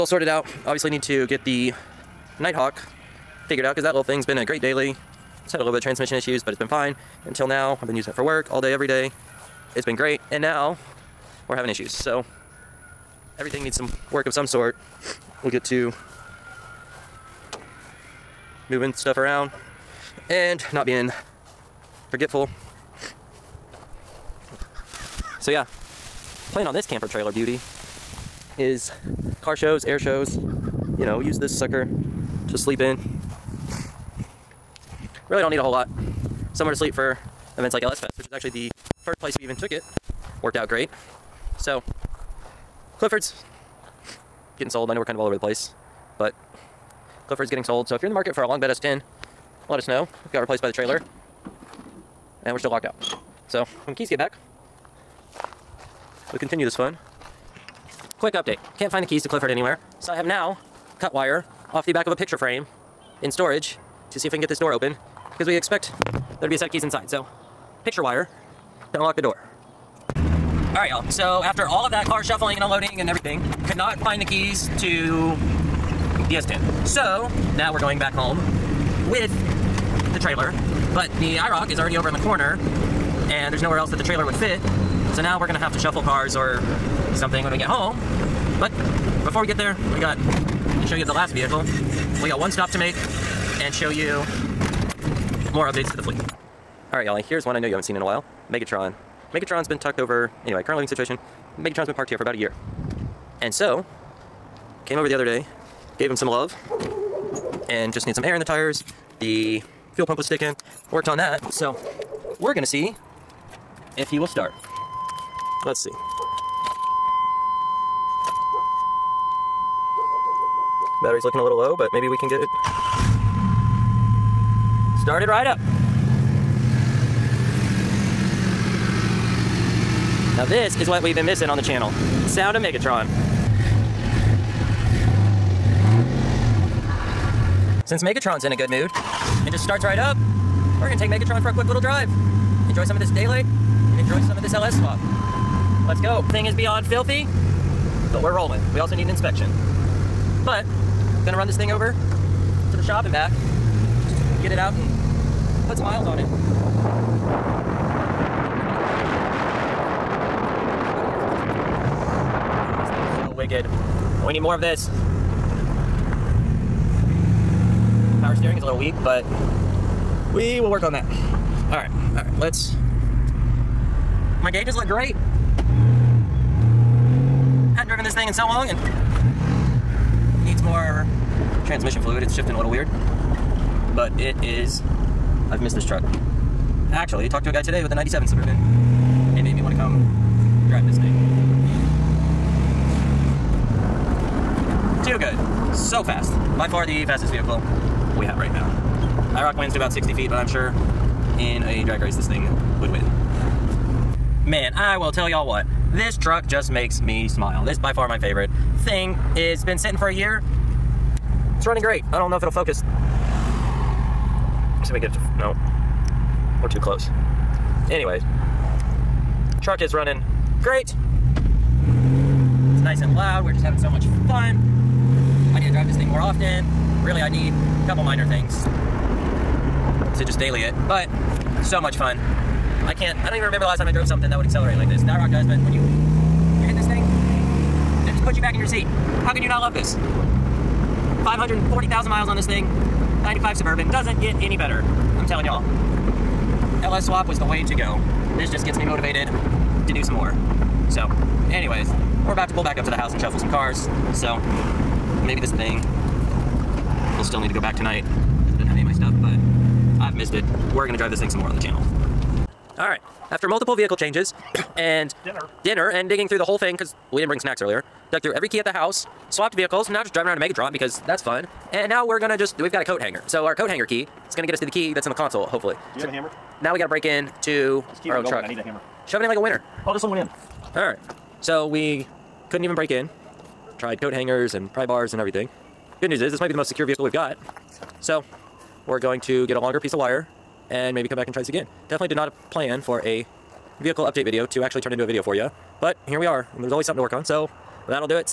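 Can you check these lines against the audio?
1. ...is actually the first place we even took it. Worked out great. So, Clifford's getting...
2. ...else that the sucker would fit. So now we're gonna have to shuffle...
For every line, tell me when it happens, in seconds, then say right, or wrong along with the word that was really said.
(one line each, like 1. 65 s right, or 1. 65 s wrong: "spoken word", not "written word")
1. 38 s right
2. 83 s wrong: "trailer", not "sucker".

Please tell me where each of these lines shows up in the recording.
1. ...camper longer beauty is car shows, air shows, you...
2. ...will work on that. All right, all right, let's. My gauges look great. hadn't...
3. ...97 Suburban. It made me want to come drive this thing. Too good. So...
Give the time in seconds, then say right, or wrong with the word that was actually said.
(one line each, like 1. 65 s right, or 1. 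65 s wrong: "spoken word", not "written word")
1. 26 s wrong: "trailer", not "longer"
2. 170 s right
3. 187 s right.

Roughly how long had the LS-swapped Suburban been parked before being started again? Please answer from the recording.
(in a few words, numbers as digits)
About a year.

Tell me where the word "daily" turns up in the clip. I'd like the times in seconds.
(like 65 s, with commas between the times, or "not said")
4 s, 230 s.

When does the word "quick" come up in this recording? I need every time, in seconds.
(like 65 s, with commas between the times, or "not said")
58 s, 141 s.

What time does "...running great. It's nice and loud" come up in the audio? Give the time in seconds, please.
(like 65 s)
219 s.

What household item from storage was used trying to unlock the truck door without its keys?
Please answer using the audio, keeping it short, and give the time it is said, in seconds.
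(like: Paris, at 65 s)
Picture wire, at 67 s.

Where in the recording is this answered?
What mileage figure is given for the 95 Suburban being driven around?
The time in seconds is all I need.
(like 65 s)
241 s.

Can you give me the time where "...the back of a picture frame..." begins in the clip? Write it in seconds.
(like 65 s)
61 s.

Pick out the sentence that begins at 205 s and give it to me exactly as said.
This truck just makes me smile.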